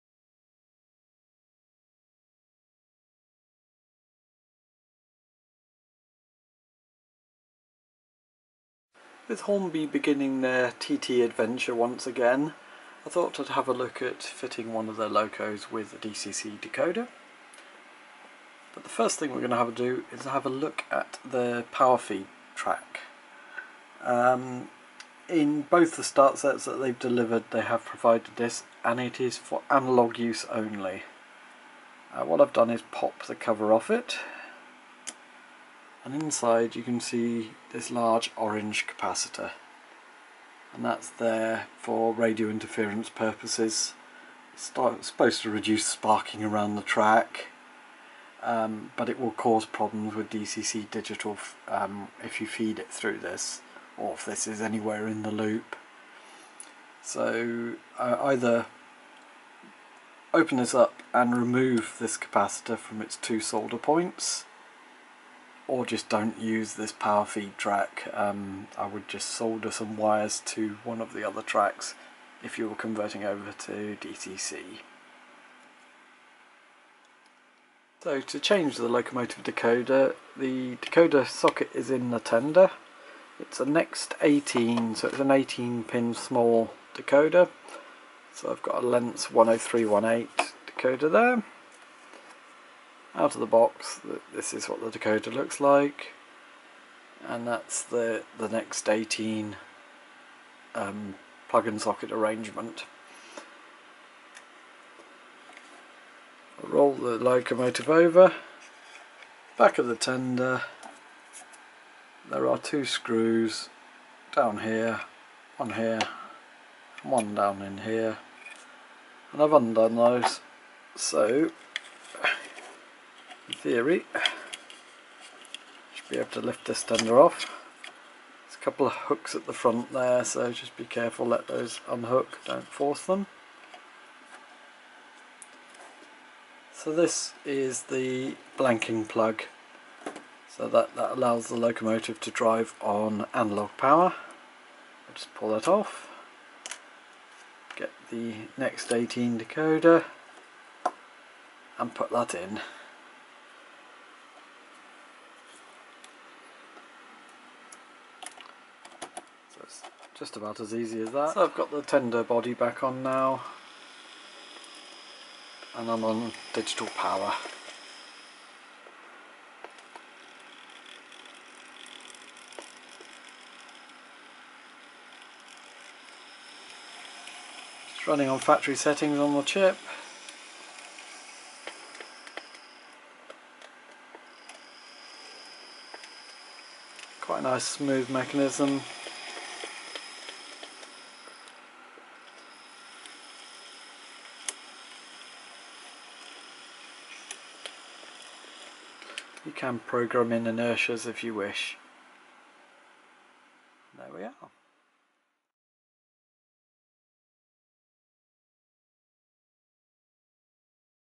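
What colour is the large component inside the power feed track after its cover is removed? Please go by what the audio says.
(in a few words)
Orange.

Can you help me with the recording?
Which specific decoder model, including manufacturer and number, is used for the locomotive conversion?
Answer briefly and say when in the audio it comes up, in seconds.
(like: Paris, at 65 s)
Lenz 10318, at 88 s.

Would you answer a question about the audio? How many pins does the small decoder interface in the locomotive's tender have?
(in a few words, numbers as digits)
18.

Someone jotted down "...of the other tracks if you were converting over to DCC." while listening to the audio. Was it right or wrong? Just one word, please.
right.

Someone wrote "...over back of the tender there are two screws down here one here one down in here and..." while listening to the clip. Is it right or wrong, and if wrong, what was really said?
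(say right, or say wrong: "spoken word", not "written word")
right.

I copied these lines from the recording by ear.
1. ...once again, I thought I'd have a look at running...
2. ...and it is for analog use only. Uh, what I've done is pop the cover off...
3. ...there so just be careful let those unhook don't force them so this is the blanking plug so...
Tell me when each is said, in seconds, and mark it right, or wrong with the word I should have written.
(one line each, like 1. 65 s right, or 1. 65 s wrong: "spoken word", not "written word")
1. 11 s wrong: "fitting", not "running"
2. 28 s right
3. 129 s right.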